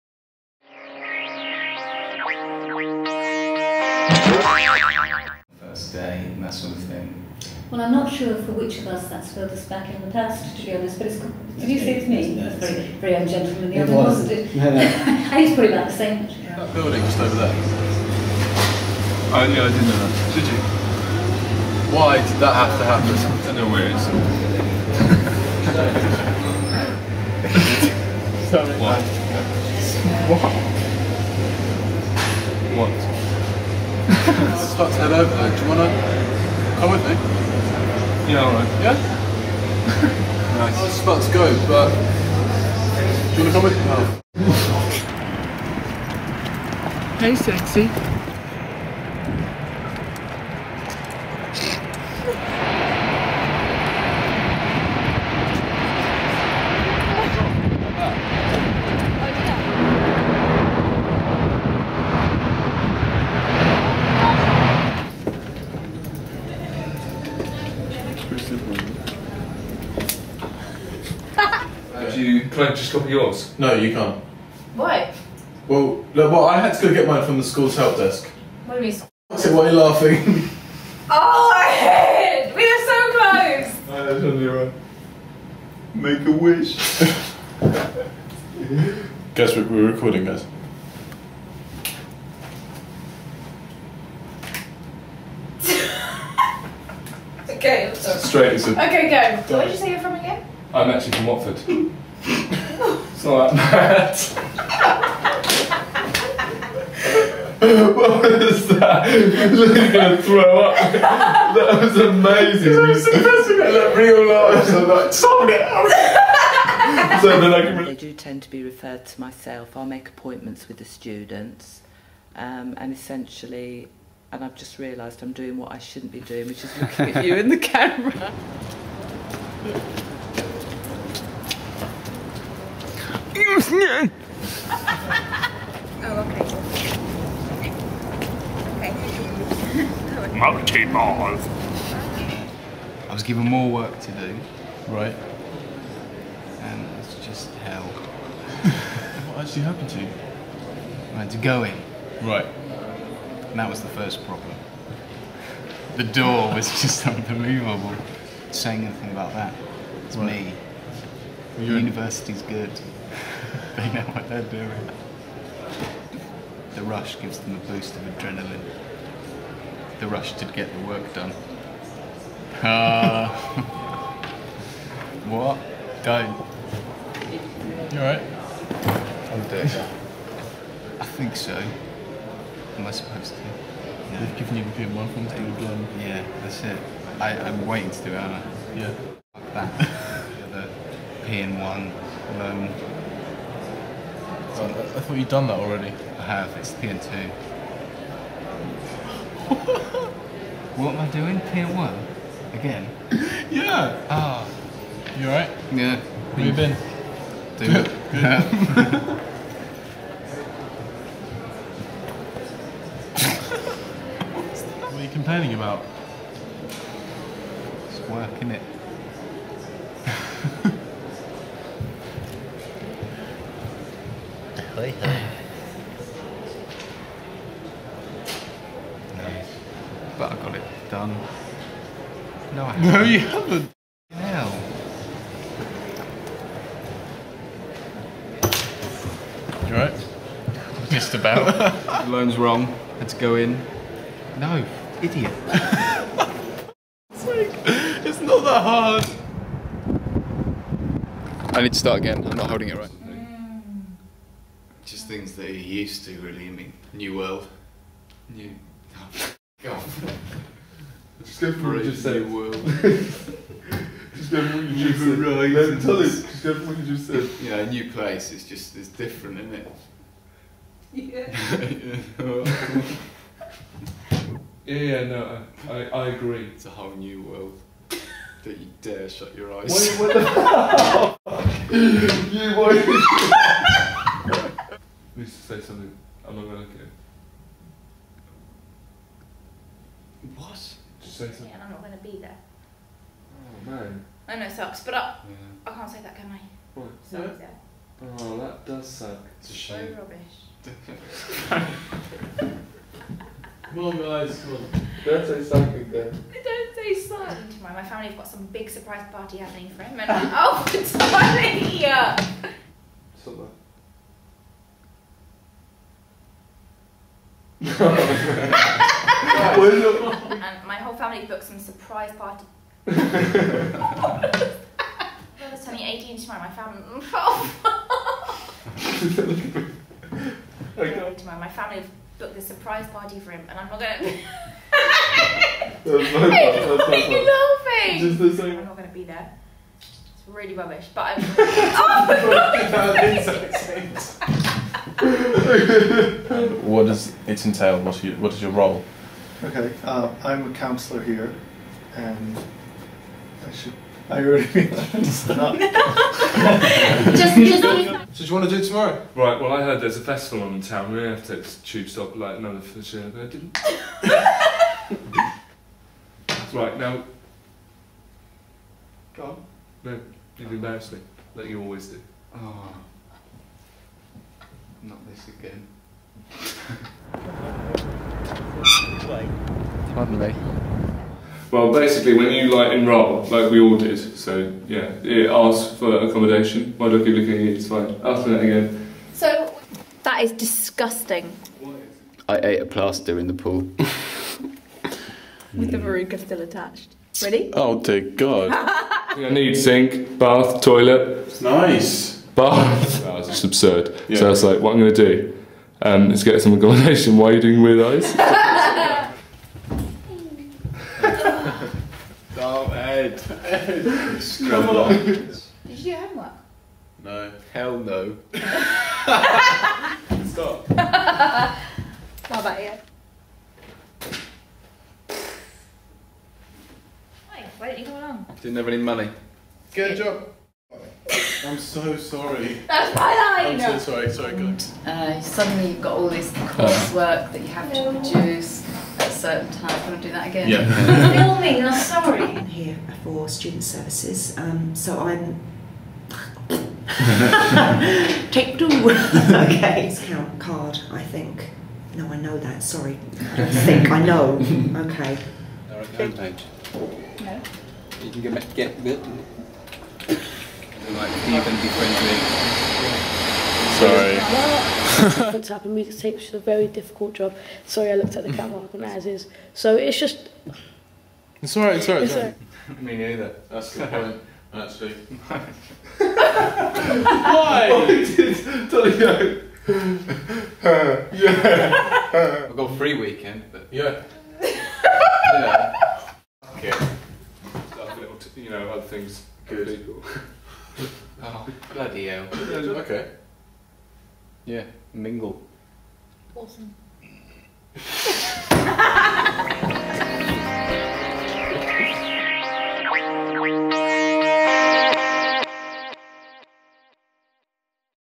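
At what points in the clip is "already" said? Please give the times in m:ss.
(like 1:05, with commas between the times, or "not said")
3:15, 5:54.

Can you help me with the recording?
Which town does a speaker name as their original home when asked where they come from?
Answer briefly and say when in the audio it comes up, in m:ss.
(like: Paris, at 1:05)
Watford, at 1:41.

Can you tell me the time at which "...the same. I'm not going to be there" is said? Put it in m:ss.
5:38.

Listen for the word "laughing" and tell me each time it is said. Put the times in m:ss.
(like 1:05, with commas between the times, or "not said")
1:19, 5:37.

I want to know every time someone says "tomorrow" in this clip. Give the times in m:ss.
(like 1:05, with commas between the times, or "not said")
5:26, 5:31, 5:58.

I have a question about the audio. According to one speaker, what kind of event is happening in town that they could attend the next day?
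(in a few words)
a festival.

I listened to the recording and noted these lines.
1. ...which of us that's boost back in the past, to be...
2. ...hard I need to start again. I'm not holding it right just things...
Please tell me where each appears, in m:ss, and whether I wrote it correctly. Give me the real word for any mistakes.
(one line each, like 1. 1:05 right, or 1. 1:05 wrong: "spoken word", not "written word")
1. 0:08 wrong: "furthest", not "boost"
2. 4:08 right.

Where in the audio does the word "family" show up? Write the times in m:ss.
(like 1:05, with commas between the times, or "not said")
5:07, 5:20, 5:26, 5:31.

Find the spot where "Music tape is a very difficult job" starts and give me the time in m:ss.
7:45.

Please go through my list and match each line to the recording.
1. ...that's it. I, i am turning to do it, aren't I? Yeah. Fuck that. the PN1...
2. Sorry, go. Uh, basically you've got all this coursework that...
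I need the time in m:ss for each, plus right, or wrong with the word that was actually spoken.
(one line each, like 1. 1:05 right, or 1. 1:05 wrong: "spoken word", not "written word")
1. 3:06 wrong: "waiting", not "turning"
2. 7:14 wrong: "suddenly", not "basically".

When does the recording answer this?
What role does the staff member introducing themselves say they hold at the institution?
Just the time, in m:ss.
5:50.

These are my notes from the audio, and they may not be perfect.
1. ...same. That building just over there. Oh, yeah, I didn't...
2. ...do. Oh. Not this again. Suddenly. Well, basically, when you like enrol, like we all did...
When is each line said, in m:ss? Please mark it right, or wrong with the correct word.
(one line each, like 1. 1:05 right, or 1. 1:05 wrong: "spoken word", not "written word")
1. 0:15 right
2. 6:11 right.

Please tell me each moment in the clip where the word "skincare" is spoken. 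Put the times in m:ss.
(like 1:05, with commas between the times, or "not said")
not said.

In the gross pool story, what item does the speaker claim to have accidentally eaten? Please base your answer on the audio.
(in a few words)
a plaster.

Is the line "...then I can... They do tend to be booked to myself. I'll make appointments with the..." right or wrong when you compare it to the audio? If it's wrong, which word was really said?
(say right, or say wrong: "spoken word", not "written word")
wrong: "referred", not "booked".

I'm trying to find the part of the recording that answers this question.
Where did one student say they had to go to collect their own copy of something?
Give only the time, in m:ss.
1:17.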